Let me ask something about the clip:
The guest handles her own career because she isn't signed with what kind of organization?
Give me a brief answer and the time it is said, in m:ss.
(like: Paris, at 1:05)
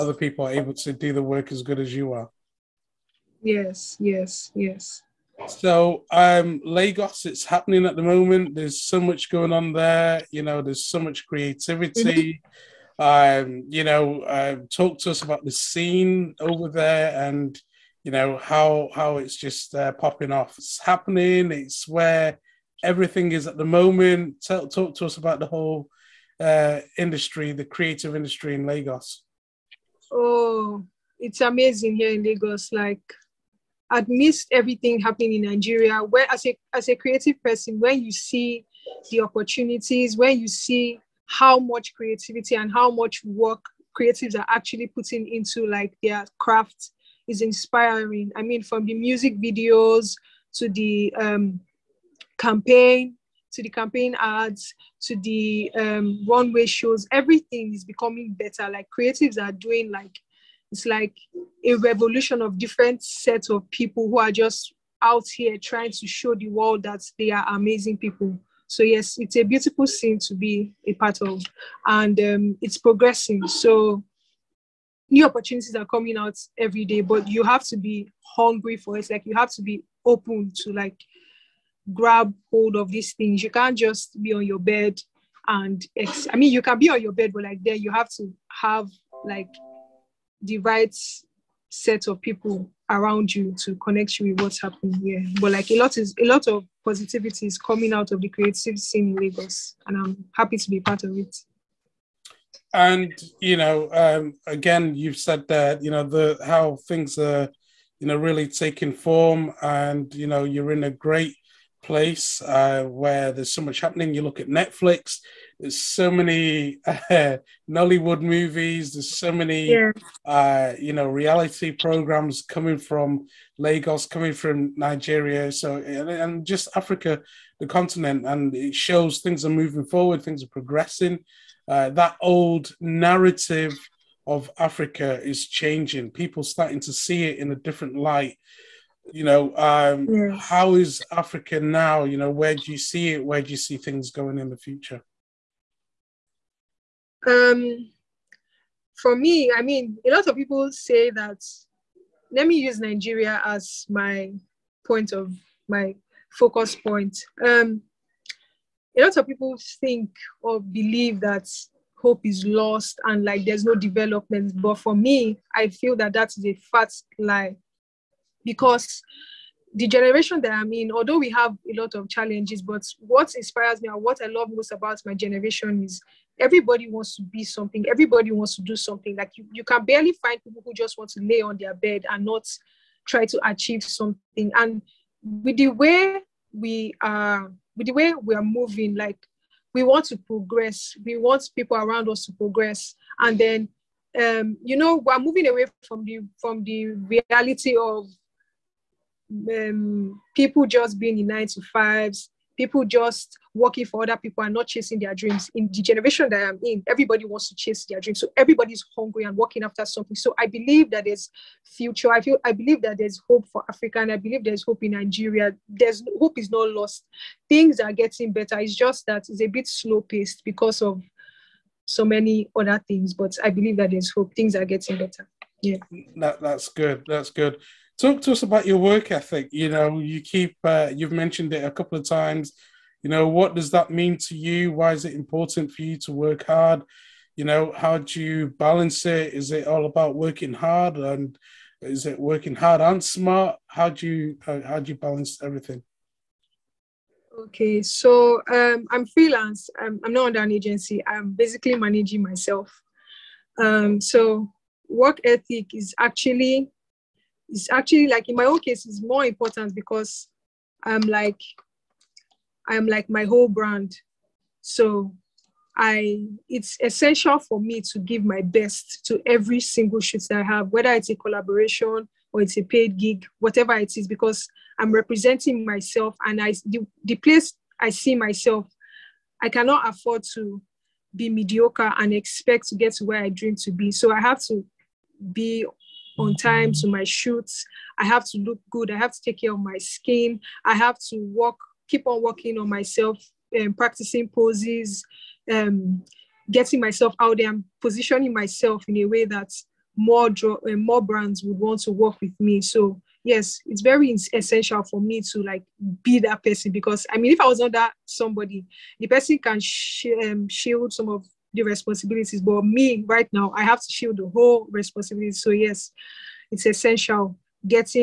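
An agency, at 4:10.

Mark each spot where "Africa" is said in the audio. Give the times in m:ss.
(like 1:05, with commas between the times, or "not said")
2:06, 2:14, 2:21, 3:33.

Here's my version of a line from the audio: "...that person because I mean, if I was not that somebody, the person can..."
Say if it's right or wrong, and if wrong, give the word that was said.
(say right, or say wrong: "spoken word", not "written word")
right.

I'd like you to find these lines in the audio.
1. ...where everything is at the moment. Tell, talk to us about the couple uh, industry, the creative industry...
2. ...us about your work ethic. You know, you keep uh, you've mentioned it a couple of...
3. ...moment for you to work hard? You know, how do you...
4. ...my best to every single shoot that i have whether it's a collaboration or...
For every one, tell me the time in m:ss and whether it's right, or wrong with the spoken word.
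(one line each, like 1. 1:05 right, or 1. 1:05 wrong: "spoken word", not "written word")
1. 0:21 wrong: "whole", not "couple"
2. 3:48 right
3. 3:55 wrong: "important", not "moment"
4. 4:28 right.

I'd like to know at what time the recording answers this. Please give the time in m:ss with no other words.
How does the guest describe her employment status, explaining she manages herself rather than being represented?
4:08.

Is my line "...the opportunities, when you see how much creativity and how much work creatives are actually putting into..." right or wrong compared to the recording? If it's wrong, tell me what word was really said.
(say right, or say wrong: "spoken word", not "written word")
right.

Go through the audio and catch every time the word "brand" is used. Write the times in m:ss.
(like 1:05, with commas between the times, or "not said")
4:23, 5:01.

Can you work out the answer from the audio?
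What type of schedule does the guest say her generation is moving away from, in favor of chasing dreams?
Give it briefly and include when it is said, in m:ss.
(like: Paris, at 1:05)
nine to fives, at 3:21.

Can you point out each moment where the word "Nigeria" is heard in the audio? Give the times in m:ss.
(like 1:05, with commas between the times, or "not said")
0:35, 2:04, 2:32, 3:34.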